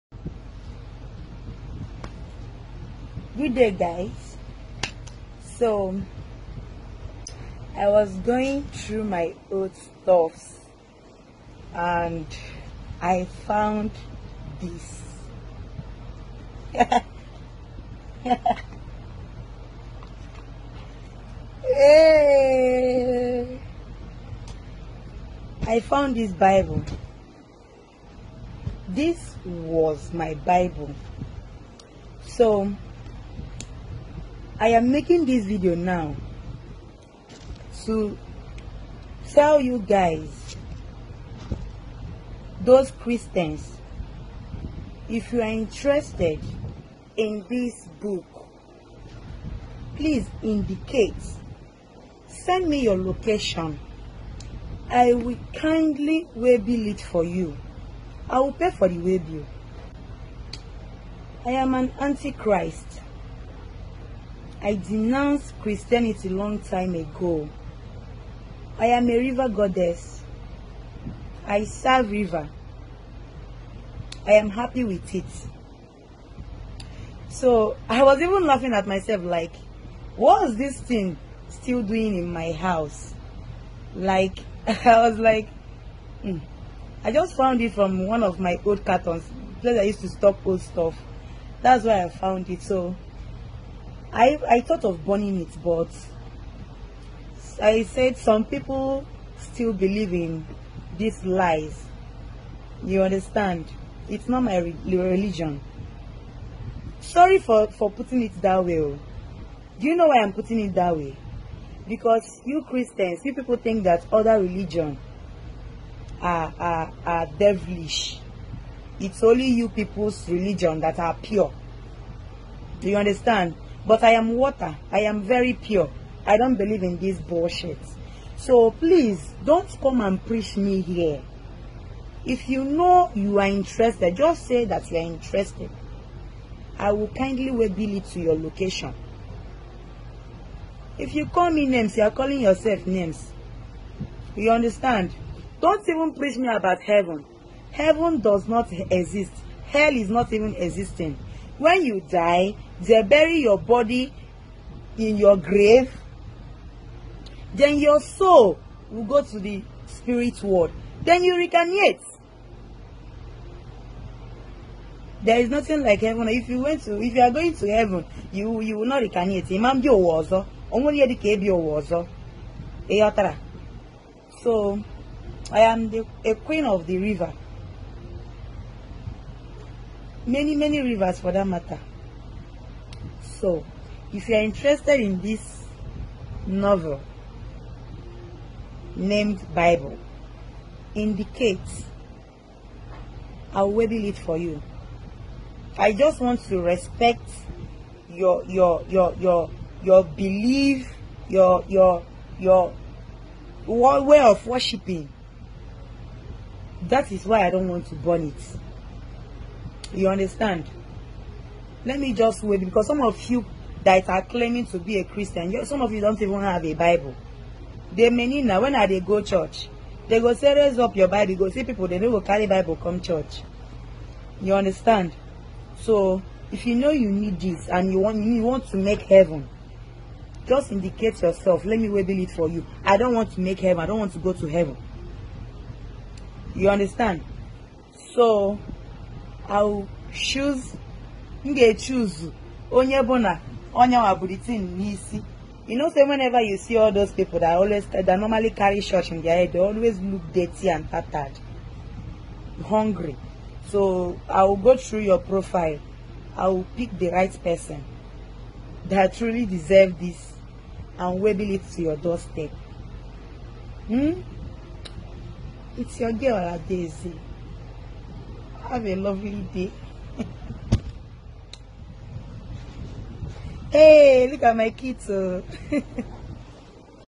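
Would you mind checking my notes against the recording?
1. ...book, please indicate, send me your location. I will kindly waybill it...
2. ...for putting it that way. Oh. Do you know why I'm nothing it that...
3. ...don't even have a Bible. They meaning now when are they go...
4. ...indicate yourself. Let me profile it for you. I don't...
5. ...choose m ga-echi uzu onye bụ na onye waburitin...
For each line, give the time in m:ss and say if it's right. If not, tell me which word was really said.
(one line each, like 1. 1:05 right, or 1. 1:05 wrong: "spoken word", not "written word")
1. 0:47 right
2. 1:47 wrong: "putting", not "nothing"
3. 3:36 right
4. 3:50 wrong: "wable", not "profile"
5. 4:00 right.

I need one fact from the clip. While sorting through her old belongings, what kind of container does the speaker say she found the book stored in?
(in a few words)
old cartons.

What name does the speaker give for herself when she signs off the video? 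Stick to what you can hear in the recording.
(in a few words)
Adaeze.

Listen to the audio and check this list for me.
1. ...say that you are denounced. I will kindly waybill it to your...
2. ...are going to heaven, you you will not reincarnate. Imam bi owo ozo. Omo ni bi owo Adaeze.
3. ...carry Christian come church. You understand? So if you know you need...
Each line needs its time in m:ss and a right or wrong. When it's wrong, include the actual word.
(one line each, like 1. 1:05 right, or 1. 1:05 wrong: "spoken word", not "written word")
1. 2:14 wrong: "interested", not "denounced"
2. 2:47 wrong: "Eyotara", not "Adaeze"
3. 3:42 wrong: "Bible", not "Christian".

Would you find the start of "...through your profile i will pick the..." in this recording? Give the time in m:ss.
4:14.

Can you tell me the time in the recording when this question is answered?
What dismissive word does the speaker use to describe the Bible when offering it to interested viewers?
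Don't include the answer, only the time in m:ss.
3:06.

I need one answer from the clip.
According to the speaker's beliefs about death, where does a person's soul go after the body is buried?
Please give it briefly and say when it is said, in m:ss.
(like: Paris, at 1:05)
the spirit world, at 2:39.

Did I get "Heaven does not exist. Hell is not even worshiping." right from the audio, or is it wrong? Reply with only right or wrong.
wrong.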